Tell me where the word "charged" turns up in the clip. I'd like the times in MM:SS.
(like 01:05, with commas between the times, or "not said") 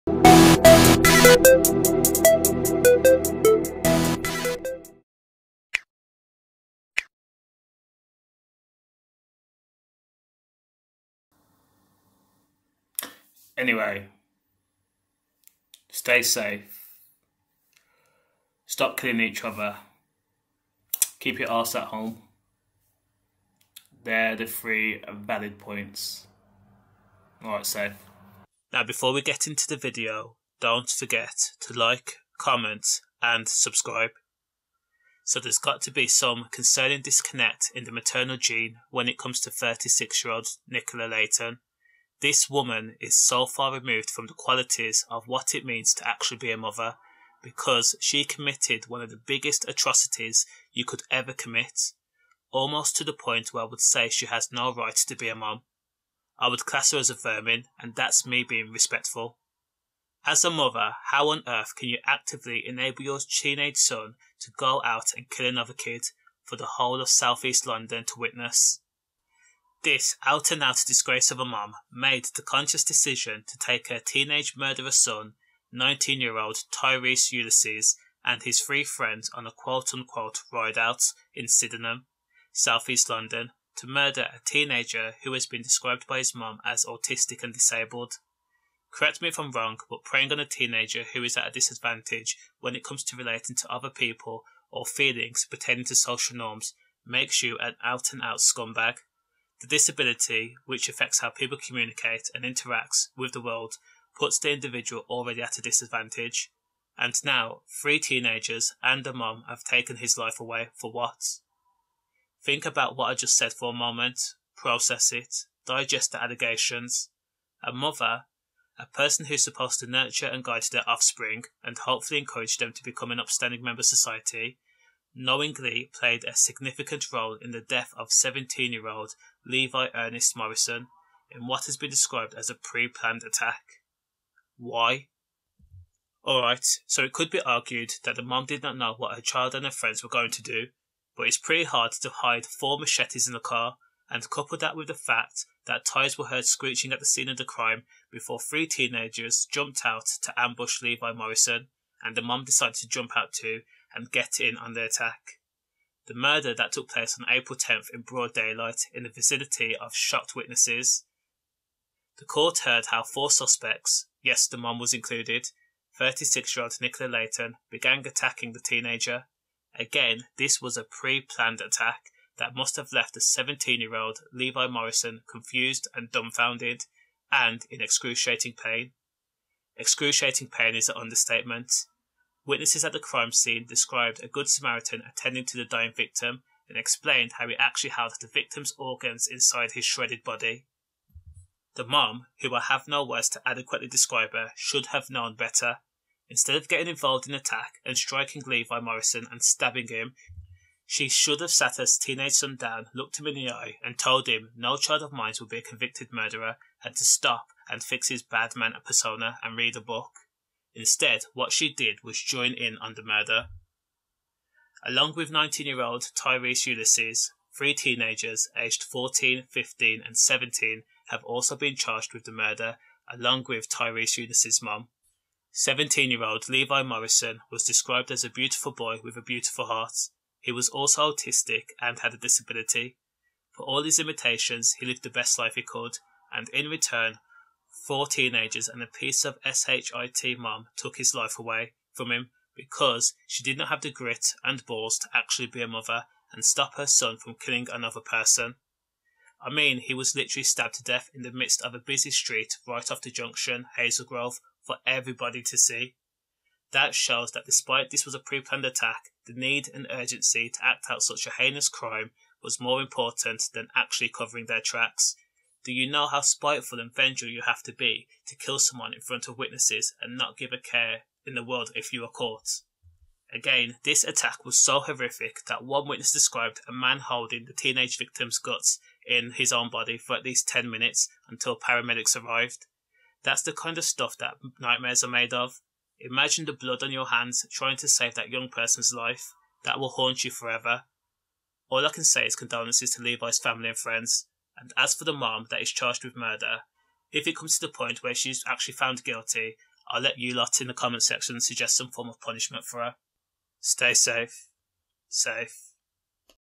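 03:41, 04:55.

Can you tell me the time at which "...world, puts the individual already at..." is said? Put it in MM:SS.
01:43.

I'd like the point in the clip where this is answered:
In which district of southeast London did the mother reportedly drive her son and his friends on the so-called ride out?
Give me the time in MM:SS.
01:21.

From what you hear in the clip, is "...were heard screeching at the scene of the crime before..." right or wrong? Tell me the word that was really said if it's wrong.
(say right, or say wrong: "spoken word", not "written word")
right.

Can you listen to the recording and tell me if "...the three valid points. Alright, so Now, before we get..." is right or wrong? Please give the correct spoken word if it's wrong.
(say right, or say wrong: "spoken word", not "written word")
right.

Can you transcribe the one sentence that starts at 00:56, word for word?
I would class her as a vermin, and that's me being respectful.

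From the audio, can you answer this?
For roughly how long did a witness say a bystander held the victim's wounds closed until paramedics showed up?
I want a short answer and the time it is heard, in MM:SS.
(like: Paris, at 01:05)
10 minutes, at 04:40.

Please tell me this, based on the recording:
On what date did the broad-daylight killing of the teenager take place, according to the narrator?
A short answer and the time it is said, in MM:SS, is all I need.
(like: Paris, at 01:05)
April 10th, at 02:37.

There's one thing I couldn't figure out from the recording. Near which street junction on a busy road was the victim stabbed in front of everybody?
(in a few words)
Hazel Grove.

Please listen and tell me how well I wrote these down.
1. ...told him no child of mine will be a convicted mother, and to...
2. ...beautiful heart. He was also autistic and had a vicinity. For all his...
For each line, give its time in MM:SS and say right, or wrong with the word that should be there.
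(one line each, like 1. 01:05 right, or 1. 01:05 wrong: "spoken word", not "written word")
1. 03:23 wrong: "murderer", not "mother"
2. 03:49 wrong: "disability", not "vicinity".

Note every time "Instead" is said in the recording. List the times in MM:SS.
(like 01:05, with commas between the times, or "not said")
03:16, 03:30.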